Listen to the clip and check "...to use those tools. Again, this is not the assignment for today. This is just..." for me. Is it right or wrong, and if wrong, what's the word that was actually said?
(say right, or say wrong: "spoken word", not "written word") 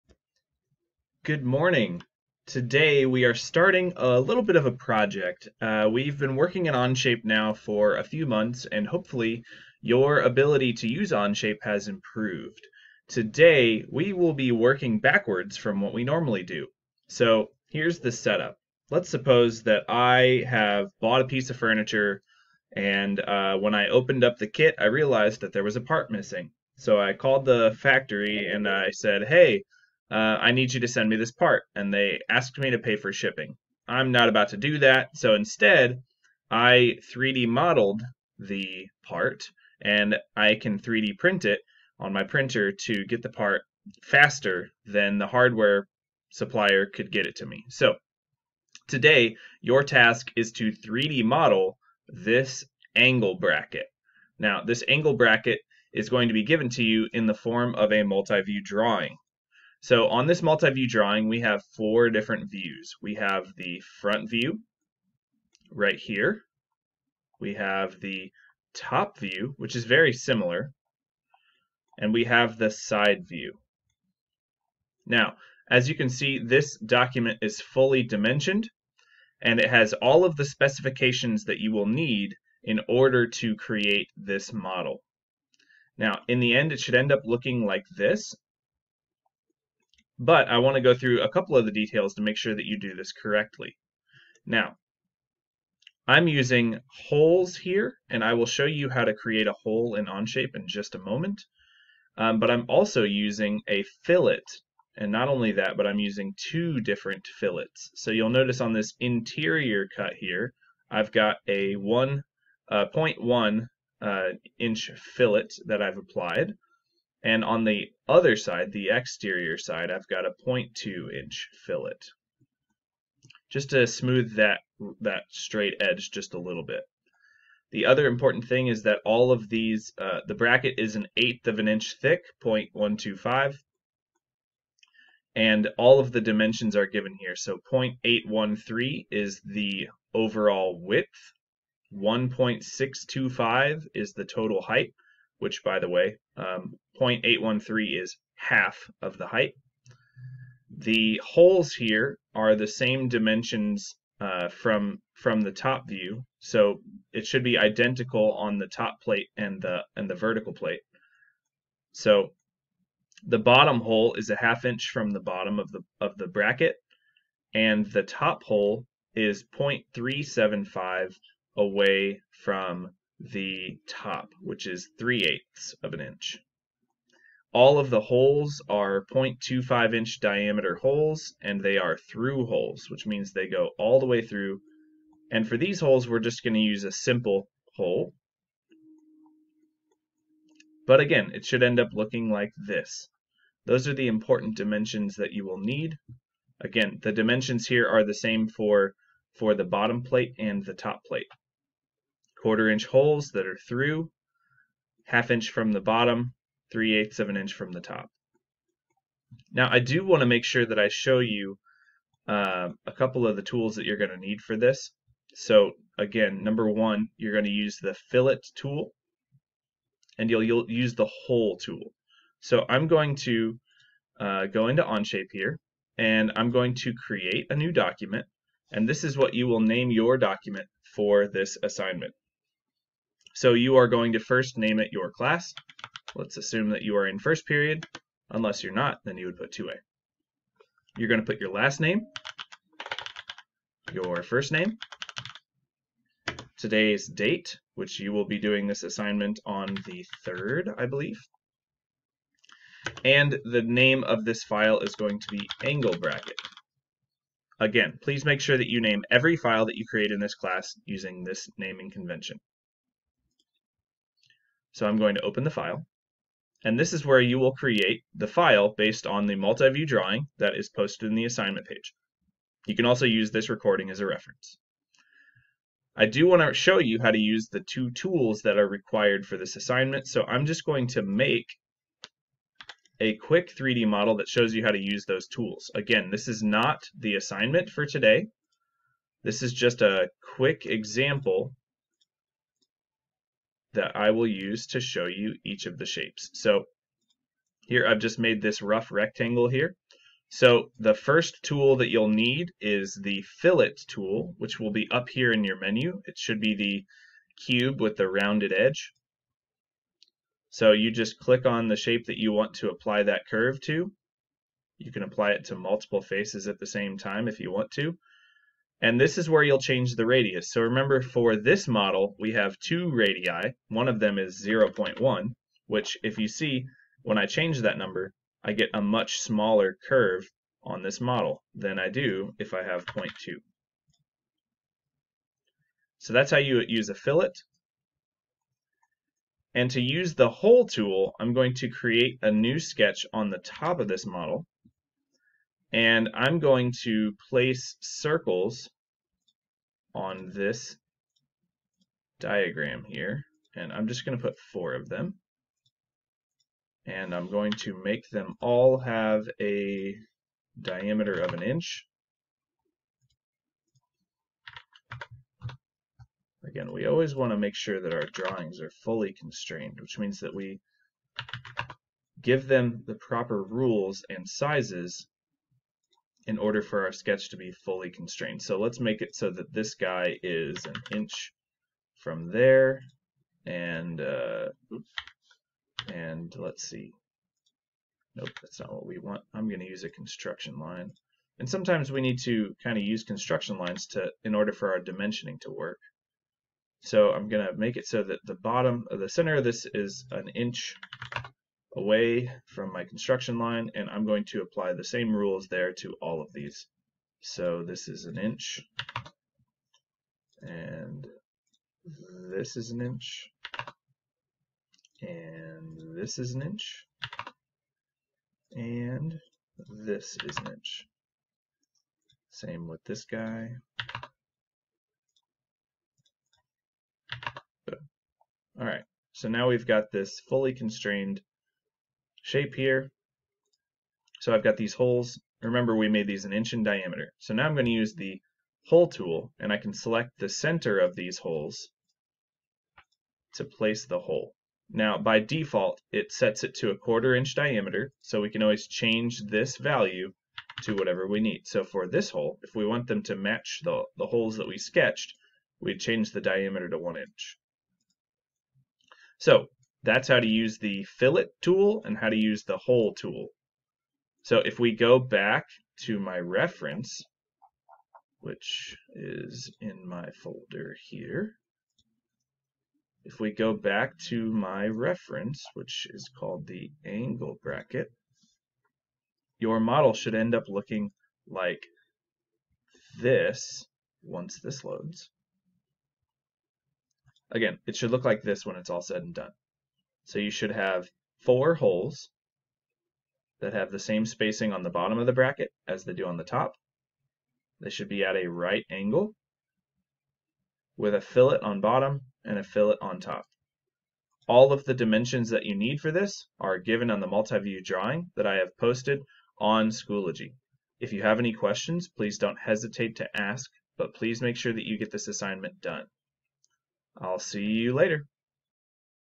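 right.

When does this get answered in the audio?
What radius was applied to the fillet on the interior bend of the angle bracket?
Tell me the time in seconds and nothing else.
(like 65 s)
111 s.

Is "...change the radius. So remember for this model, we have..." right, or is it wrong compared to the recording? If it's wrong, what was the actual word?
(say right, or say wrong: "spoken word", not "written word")
right.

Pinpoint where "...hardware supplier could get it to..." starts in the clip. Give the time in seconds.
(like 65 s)
45 s.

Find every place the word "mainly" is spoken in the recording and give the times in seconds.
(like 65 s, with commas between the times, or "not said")
not said.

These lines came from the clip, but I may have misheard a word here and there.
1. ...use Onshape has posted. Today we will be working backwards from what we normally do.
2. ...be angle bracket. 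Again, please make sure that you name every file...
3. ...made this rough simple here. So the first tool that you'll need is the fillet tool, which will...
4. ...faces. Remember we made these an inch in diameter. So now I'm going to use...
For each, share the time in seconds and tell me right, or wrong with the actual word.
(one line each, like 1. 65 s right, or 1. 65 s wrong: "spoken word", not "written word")
1. 10 s wrong: "improved", not "posted"
2. 255 s right
3. 298 s wrong: "rectangle", not "simple"
4. 434 s wrong: "holes", not "faces".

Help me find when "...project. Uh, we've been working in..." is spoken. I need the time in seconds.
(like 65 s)
4 s.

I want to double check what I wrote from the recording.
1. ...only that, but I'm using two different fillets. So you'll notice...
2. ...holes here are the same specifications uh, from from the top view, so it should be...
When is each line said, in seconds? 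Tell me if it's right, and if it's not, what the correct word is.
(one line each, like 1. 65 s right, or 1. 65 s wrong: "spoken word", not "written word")
1. 105 s right
2. 151 s wrong: "dimensions", not "specifications".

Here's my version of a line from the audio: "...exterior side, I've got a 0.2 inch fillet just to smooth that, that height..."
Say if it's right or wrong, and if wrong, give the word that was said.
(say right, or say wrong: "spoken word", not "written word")
wrong: "straight", not "height".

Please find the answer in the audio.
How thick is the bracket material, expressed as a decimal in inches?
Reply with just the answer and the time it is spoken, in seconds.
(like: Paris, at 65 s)
0.125, at 132 s.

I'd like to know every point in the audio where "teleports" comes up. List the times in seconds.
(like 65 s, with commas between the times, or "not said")
not said.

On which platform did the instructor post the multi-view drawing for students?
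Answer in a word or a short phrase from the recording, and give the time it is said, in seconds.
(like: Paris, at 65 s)
Schoology, at 509 s.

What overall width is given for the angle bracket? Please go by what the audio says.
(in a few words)
0.813.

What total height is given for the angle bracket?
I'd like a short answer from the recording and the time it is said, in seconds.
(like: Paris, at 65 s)
1.625, at 141 s.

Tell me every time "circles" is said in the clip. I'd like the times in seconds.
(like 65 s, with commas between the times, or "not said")
347 s.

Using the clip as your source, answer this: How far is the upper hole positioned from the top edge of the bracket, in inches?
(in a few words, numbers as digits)
0.375.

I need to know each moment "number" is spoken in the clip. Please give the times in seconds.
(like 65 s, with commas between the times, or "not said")
216 s, 327 s.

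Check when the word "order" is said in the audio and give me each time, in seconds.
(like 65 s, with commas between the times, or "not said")
82 s, 376 s, 394 s.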